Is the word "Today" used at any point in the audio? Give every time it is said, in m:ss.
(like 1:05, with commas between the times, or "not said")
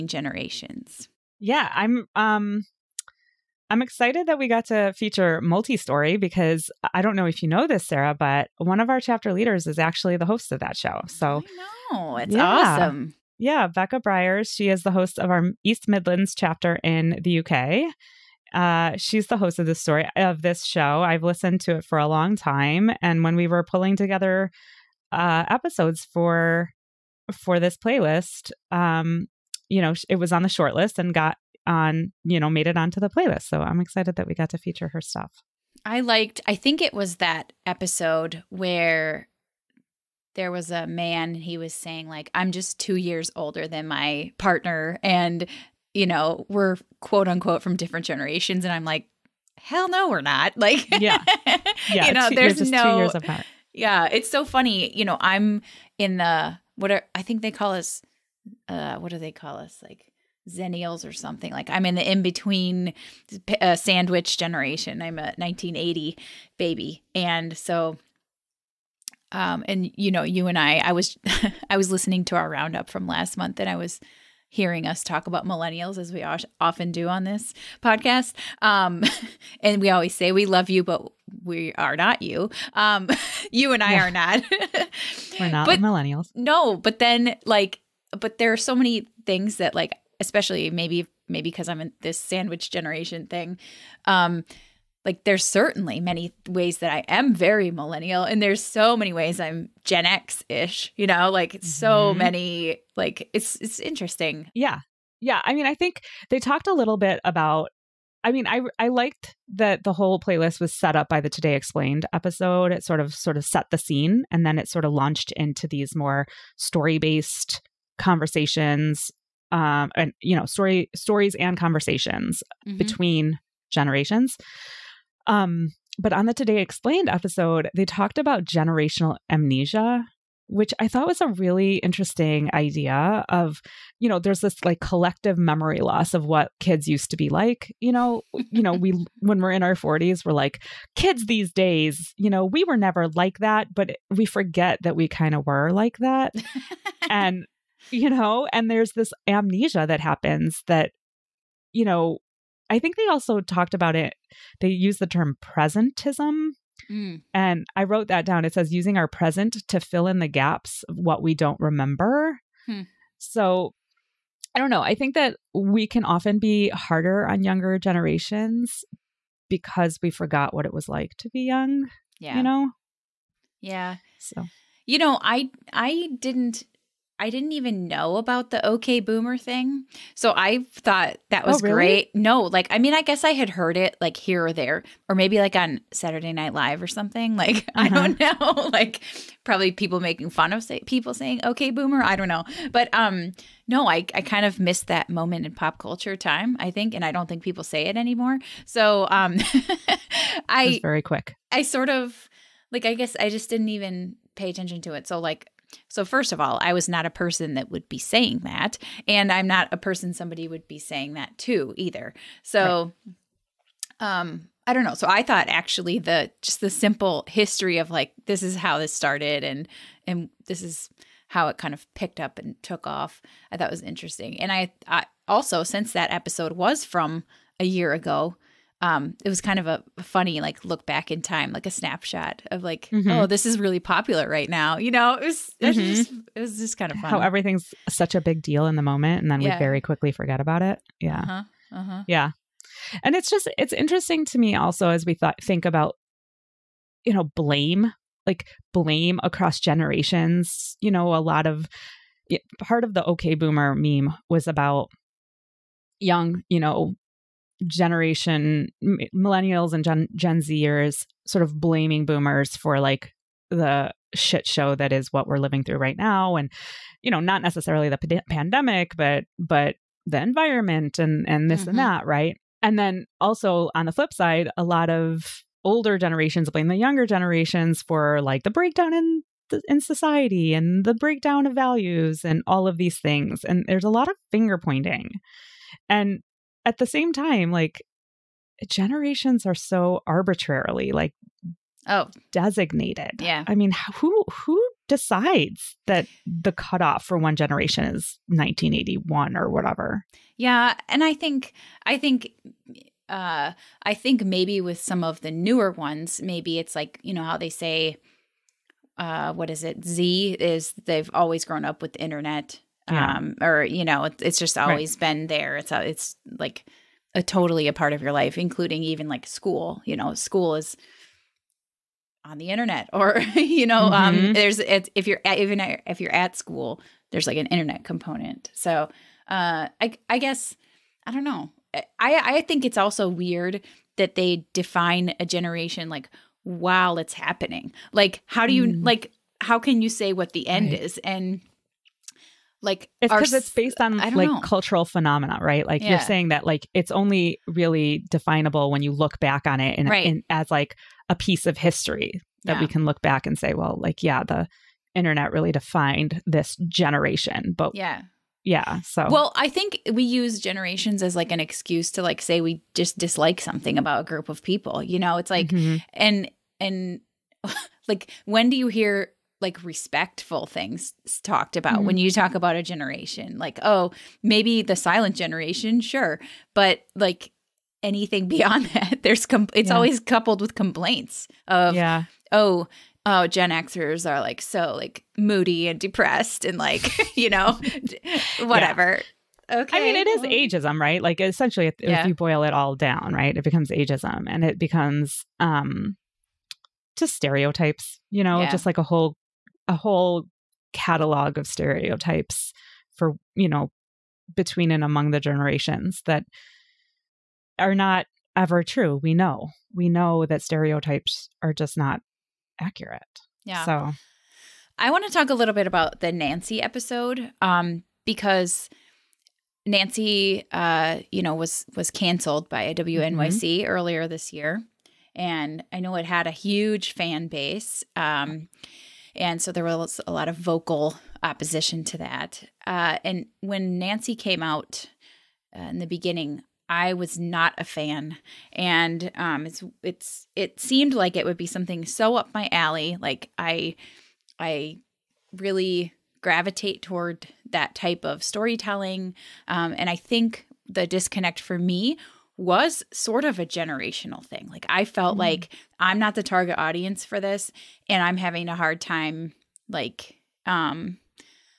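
1:51, 2:06.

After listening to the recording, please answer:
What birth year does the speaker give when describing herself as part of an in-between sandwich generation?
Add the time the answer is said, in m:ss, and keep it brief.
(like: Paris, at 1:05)
1980, at 1:05.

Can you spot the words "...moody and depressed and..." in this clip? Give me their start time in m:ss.
6:25.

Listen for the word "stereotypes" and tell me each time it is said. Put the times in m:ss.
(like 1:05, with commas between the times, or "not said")
6:37, 6:41, 6:50.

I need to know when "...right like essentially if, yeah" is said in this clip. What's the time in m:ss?
6:30.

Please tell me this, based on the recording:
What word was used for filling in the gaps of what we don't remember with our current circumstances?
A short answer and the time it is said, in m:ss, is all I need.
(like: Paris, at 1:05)
presentism, at 2:35.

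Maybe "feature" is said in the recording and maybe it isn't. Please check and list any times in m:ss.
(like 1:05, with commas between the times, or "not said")
0:04, 0:34.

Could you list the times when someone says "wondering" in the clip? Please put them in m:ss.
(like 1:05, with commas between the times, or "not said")
not said.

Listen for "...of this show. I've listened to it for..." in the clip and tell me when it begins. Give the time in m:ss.
0:20.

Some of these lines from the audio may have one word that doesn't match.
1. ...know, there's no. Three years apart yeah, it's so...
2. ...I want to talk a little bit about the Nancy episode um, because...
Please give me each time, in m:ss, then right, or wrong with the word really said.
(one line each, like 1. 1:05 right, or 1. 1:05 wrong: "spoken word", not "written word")
1. 0:52 wrong: "Two", not "Three"
2. 6:54 right.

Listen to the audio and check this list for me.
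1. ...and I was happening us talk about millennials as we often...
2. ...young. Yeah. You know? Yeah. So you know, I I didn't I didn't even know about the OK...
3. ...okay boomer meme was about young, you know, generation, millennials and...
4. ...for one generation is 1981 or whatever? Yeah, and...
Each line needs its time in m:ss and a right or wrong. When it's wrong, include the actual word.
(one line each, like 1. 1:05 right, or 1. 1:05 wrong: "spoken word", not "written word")
1. 1:13 wrong: "hearing", not "happening"
2. 2:51 right
3. 4:13 right
4. 4:57 right.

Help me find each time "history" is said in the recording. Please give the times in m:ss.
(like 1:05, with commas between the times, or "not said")
3:37, 5:51.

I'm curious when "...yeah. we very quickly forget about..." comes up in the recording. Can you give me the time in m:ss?
3:59.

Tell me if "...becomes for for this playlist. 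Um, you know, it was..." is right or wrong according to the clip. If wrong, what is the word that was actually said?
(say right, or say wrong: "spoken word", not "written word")
wrong: "episodes", not "becomes".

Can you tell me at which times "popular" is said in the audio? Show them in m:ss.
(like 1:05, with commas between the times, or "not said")
3:53.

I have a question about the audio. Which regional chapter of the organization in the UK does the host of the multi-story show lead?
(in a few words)
East Midlands.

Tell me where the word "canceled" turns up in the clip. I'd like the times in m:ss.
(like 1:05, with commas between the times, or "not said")
7:01.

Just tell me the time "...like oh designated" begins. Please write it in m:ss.
4:50.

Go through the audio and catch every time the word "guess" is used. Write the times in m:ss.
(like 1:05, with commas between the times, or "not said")
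3:03, 3:22, 5:30.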